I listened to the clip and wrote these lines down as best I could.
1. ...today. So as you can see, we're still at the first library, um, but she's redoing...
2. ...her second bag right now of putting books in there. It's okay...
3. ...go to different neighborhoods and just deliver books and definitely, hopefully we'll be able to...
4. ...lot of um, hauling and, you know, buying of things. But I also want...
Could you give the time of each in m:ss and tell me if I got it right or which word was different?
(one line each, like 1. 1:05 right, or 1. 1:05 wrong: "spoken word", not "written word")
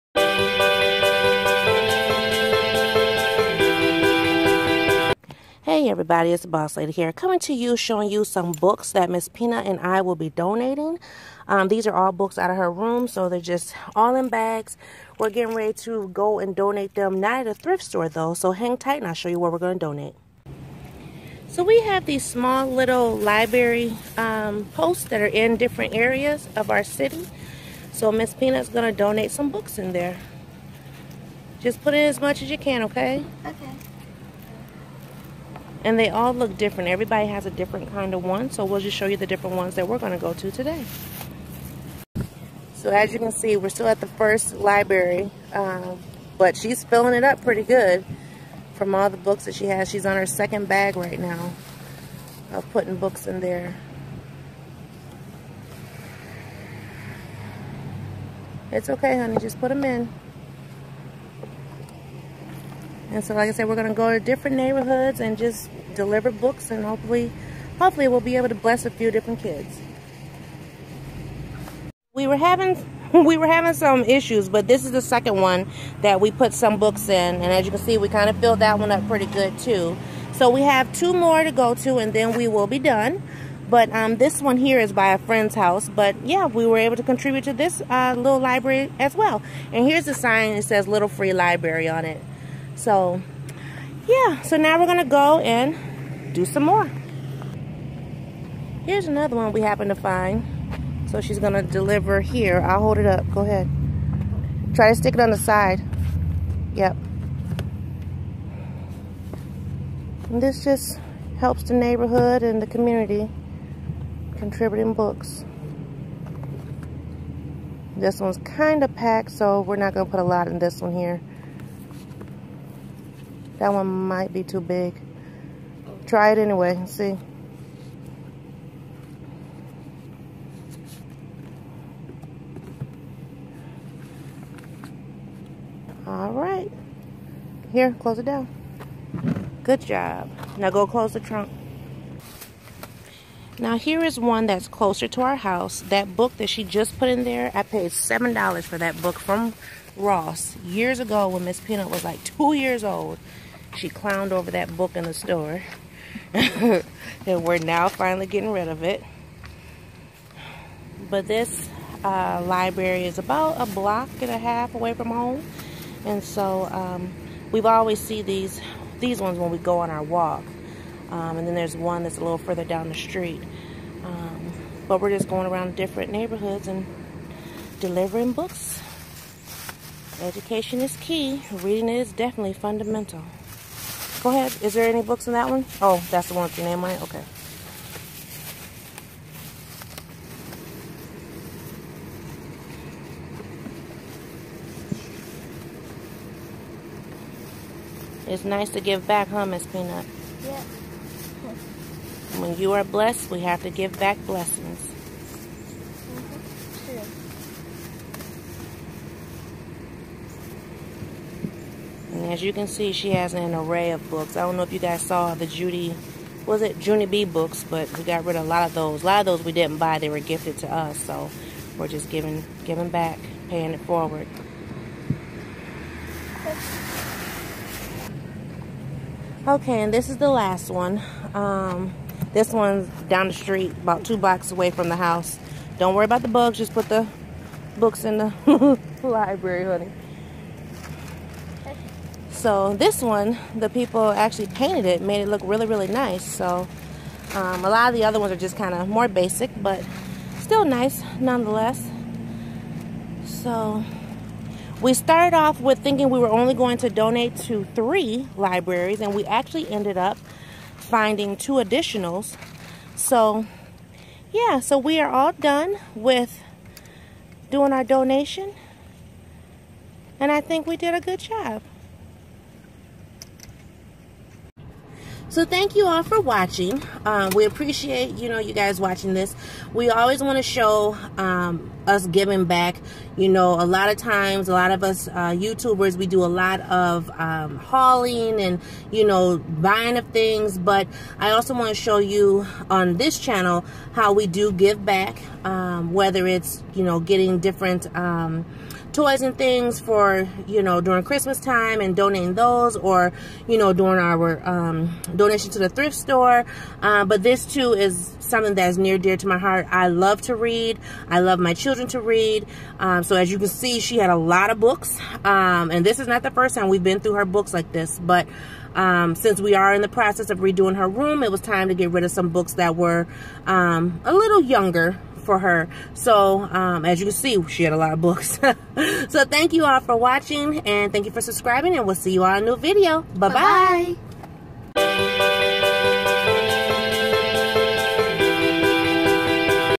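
1. 0:40 wrong: "filling", not "redoing"
2. 0:50 right
3. 1:03 wrong: "hopefully", not "definitely"
4. 4:46 right.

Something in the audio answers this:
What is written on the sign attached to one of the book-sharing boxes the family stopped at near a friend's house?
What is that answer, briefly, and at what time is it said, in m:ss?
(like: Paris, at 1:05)
Little Free Library, at 1:30.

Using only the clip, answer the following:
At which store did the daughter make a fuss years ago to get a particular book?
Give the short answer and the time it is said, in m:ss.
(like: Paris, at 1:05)
Ross, at 2:29.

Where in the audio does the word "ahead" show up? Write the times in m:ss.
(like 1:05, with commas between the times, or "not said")
1:43, 3:04.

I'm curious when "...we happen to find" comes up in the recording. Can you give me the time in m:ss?
1:39.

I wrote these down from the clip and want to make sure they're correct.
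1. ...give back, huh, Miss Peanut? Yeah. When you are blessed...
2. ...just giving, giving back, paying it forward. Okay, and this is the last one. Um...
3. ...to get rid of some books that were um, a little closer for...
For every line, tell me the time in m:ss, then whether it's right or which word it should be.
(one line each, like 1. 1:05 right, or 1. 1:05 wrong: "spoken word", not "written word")
1. 3:18 right
2. 3:41 right
3. 5:21 wrong: "younger", not "closer".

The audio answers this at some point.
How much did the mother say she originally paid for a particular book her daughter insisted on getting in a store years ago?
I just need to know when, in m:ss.
2:27.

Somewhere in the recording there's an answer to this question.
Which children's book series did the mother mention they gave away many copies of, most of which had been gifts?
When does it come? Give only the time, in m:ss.
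3:36.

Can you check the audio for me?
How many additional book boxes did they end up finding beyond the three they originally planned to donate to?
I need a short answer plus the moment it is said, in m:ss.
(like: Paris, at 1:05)
2, at 4:21.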